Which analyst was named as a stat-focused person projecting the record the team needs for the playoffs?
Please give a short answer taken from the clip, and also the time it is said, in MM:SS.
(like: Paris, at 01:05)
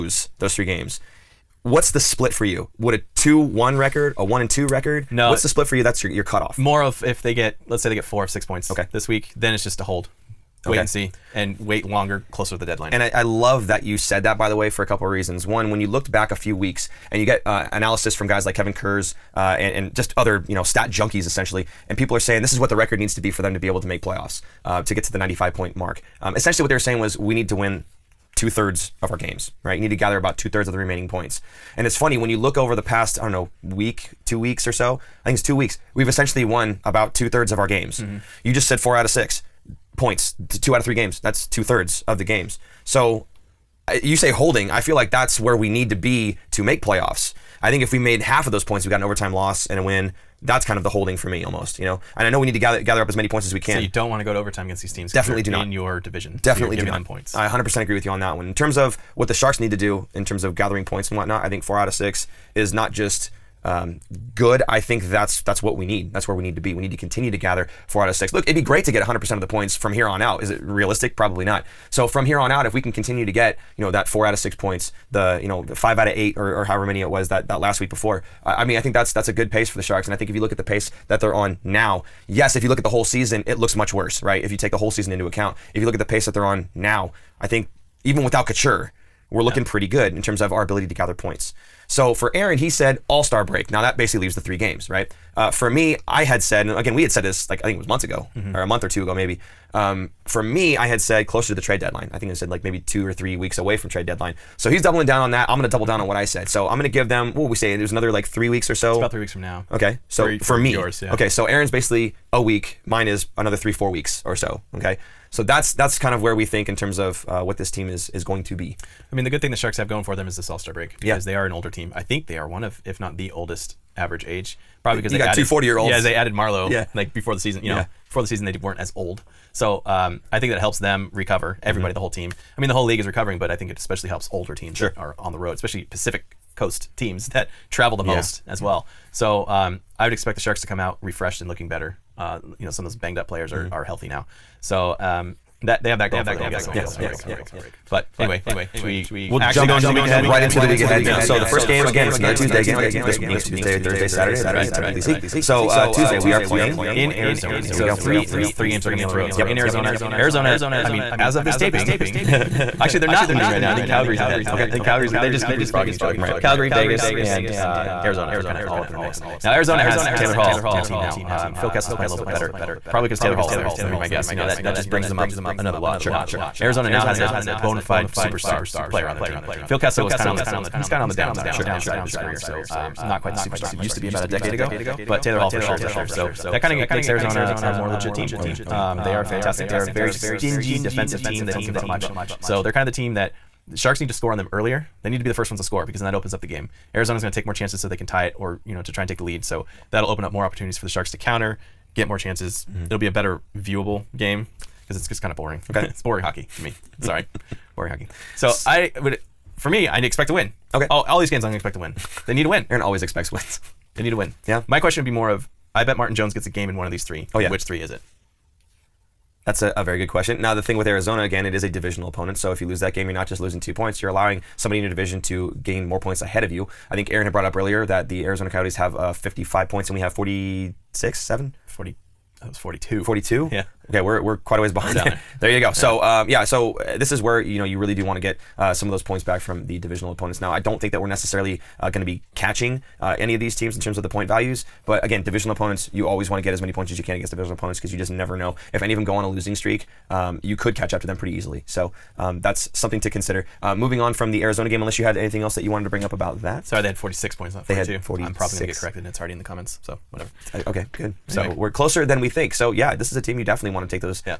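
Kevin Kurz, at 00:18.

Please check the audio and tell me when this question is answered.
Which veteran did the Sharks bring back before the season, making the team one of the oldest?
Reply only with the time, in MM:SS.
02:06.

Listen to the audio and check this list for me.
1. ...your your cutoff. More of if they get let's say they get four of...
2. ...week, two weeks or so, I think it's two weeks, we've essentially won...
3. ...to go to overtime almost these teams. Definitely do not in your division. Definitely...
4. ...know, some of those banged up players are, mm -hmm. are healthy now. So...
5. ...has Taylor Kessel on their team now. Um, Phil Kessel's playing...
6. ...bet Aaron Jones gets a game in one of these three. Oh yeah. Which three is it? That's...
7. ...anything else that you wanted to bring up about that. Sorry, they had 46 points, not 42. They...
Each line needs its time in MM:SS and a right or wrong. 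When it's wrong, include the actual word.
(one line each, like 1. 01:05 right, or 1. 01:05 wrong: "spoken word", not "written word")
1. 00:06 right
2. 00:33 right
3. 00:54 wrong: "against", not "almost"
4. 02:22 right
5. 02:49 wrong: "Hall", not "Kessel"
6. 03:35 wrong: "Martin", not "Aaron"
7. 04:15 right.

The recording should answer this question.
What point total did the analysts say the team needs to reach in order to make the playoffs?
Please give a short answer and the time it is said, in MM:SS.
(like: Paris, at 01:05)
95, at 00:25.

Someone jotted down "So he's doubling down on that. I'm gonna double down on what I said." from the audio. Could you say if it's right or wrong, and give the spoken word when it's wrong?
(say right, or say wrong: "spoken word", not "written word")
right.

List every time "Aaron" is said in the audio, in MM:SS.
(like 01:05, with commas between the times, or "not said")
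01:32, 01:51, 03:32, 03:47.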